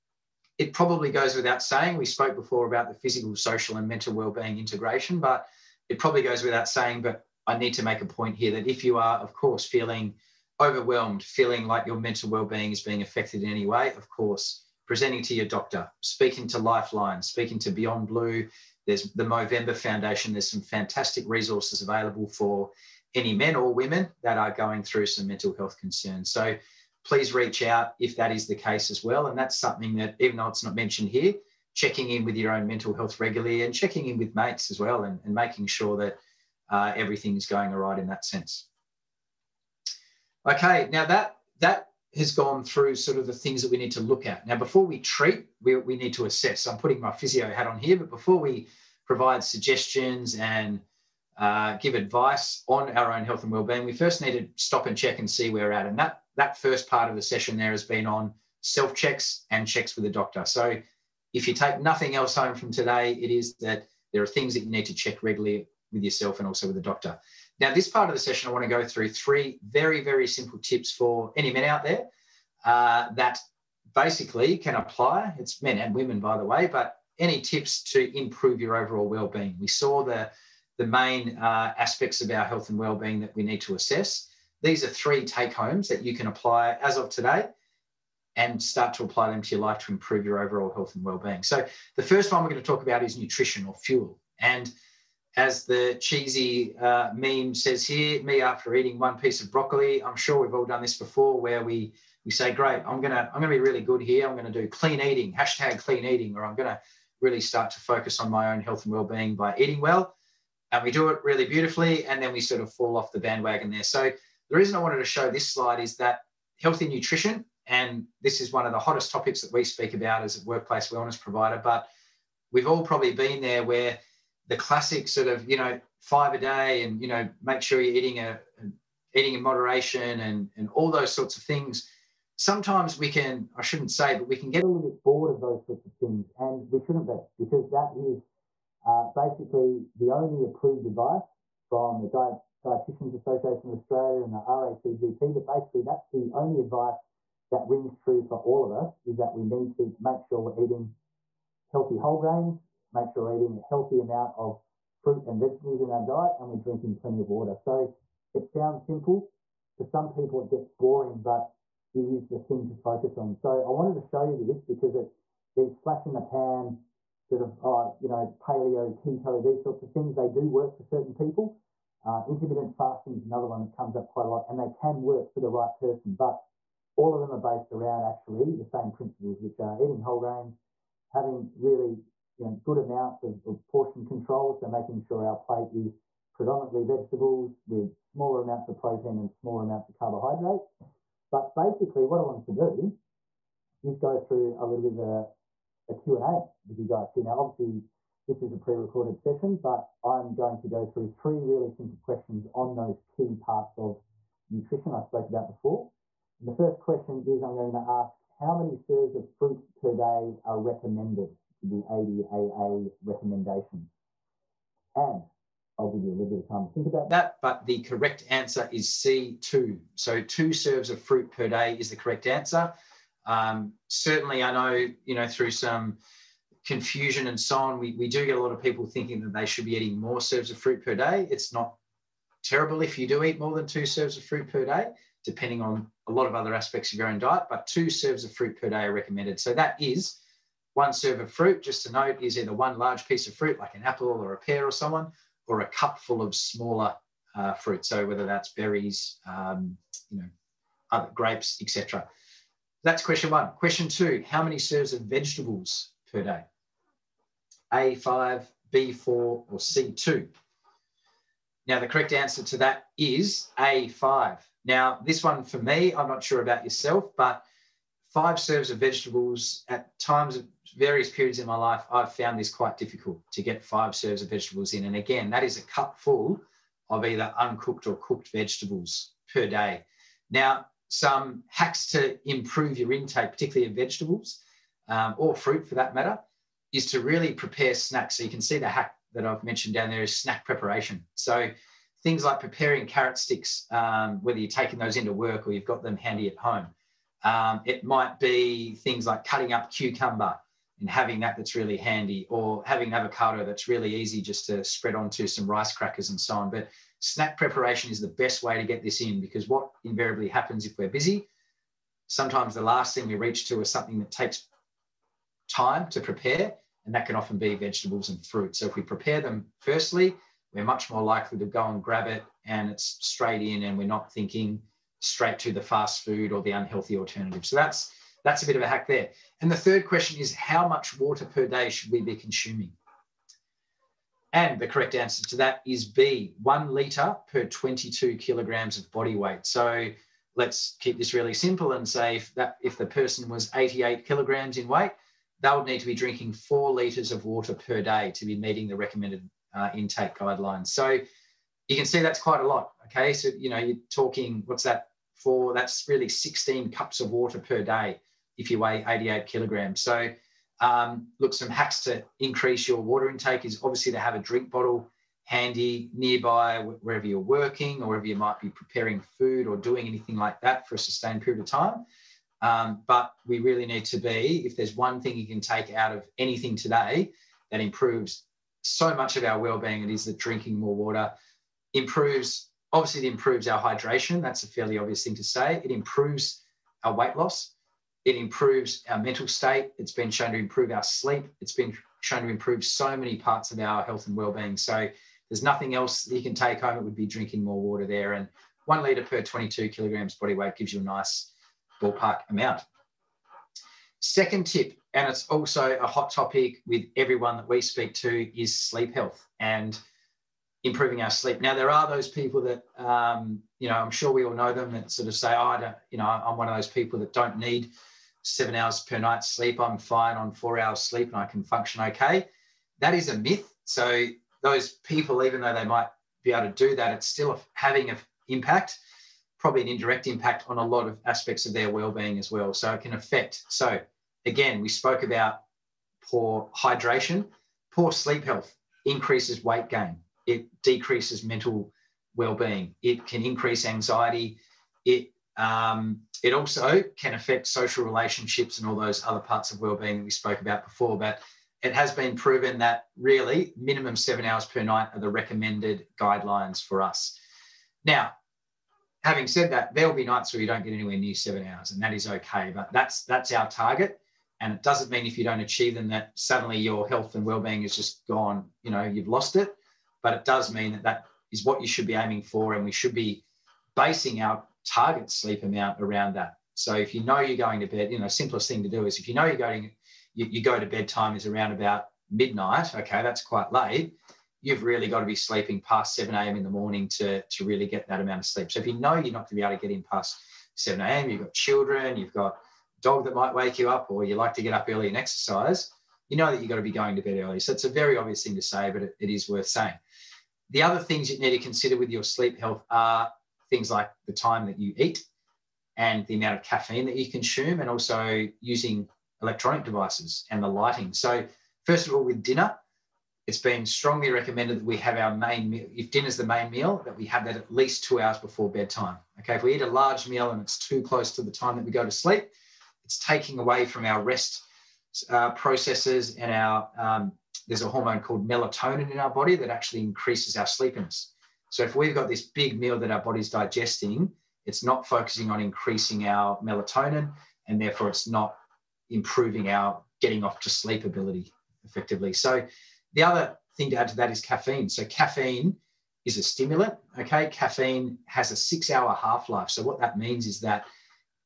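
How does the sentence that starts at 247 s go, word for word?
So whether that's berries, um, you know, other grapes, etc.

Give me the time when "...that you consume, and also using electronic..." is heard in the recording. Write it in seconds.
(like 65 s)
506 s.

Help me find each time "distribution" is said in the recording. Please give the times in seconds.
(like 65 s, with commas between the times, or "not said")
not said.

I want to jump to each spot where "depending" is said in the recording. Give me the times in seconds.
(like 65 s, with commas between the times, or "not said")
235 s.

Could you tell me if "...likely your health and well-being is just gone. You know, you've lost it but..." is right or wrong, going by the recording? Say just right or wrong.
wrong.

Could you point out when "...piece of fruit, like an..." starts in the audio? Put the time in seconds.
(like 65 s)
243 s.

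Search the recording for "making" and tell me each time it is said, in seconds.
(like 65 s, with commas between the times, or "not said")
35 s, 184 s.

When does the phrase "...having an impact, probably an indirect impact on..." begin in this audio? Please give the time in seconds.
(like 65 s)
427 s.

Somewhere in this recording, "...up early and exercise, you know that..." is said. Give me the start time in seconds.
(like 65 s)
494 s.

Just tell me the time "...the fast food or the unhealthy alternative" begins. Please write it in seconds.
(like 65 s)
325 s.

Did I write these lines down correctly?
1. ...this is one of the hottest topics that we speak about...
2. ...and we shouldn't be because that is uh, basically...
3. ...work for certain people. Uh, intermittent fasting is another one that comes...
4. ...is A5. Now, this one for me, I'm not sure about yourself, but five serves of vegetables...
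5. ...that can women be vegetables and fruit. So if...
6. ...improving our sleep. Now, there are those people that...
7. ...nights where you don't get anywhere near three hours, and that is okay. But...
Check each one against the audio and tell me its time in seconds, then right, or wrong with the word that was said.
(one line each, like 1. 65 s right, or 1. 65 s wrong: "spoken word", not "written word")
1. 118 s right
2. 136 s right
3. 170 s right
4. 262 s right
5. 316 s wrong: "often", not "women"
6. 410 s right
7. 460 s wrong: "seven", not "three".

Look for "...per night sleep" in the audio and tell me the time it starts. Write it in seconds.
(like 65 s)
418 s.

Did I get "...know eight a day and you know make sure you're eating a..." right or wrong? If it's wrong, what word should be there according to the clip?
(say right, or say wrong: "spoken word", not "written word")
wrong: "five", not "eight".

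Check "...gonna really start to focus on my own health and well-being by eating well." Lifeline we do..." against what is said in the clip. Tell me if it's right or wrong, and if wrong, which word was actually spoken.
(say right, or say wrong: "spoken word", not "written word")
wrong: "And", not "Lifeline".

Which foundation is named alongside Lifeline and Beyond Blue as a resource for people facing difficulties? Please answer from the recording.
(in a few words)
Movember Foundation.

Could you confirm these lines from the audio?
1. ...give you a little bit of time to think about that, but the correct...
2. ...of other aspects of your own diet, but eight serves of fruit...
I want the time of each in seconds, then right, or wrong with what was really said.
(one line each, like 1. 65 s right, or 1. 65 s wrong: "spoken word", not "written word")
1. 215 s right
2. 236 s wrong: "two", not "eight".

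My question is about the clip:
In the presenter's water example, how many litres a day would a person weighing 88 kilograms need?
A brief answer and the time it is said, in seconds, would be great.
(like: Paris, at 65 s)
4 litres, at 346 s.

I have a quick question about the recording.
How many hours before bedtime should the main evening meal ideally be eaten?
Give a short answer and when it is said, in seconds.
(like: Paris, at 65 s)
2 hours, at 517 s.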